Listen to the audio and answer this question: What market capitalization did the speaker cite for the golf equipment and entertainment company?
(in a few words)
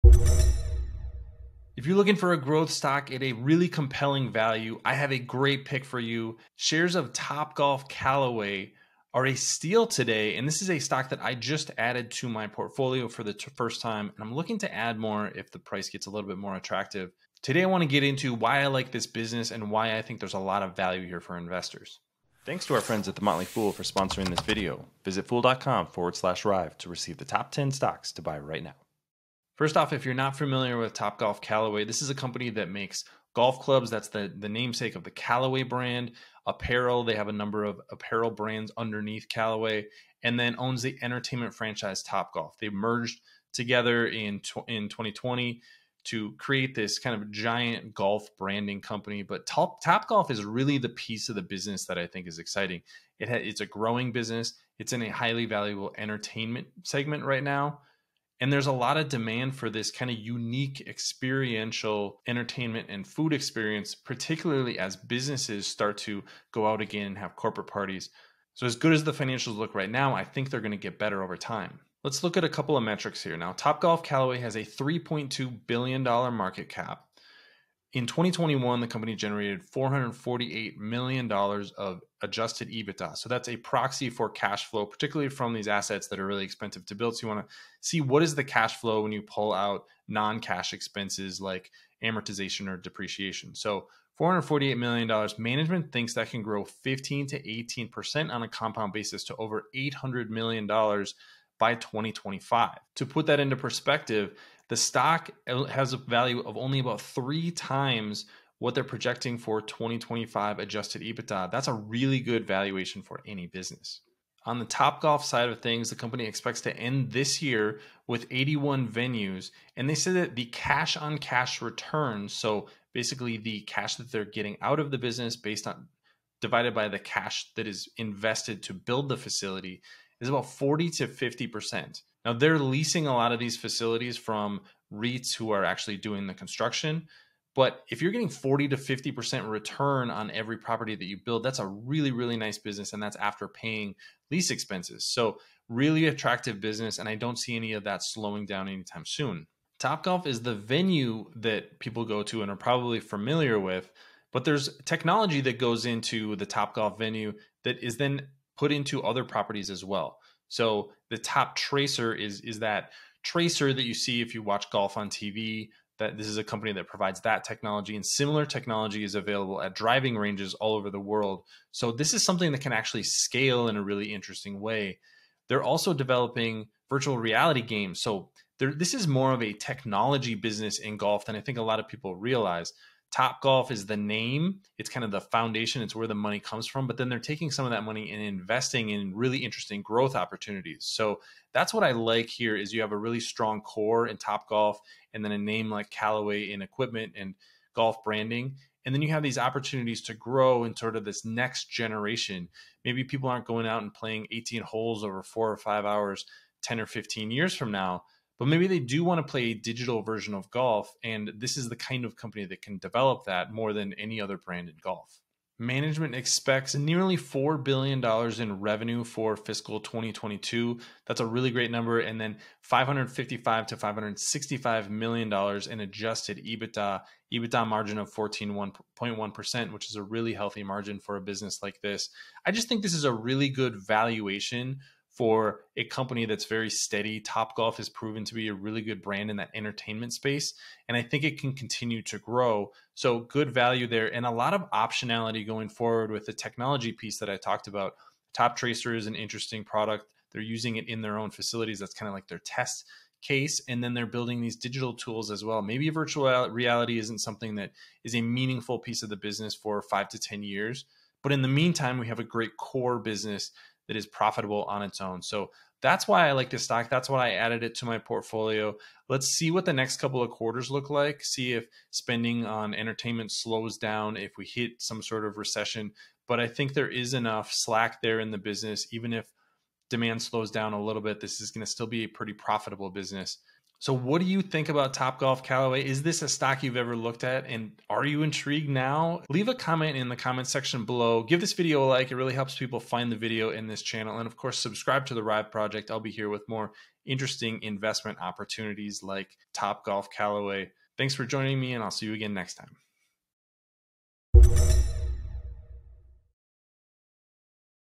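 $3.2 billion.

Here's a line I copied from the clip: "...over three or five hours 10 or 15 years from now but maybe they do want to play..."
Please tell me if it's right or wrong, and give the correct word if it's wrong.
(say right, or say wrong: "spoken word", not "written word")
wrong: "four", not "three".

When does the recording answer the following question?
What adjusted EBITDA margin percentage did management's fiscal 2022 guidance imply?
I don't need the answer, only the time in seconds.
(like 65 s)
228 s.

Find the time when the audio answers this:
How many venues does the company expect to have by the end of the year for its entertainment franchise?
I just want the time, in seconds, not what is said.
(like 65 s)
118 s.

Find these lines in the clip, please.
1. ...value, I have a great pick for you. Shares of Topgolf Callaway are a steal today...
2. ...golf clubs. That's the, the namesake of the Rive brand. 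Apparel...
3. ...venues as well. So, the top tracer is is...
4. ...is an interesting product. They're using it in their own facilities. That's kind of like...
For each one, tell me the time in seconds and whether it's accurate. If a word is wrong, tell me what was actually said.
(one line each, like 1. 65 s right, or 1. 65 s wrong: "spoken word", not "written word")
1. 4 s right
2. 33 s wrong: "Callaway", not "Rive"
3. 159 s wrong: "properties", not "venues"
4. 248 s right.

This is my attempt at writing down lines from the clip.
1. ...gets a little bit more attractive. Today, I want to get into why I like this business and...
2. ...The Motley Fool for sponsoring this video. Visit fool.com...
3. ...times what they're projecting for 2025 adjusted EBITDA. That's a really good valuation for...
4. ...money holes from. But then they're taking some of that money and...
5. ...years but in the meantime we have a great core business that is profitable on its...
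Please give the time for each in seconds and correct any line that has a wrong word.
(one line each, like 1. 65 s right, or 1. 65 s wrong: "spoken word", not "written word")
1. 15 s right
2. 23 s right
3. 107 s right
4. 186 s wrong: "comes", not "holes"
5. 260 s right.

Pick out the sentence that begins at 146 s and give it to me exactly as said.
And I don't see any of that slowing down anytime soon.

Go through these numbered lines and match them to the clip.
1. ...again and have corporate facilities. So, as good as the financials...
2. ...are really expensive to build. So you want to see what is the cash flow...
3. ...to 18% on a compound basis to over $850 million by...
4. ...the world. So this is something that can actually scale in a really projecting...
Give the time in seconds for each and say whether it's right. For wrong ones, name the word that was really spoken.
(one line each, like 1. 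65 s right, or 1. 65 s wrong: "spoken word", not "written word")
1. 66 s wrong: "parties", not "facilities"
2. 86 s right
3. 97 s wrong: "800", not "850"
4. 170 s wrong: "interesting", not "projecting".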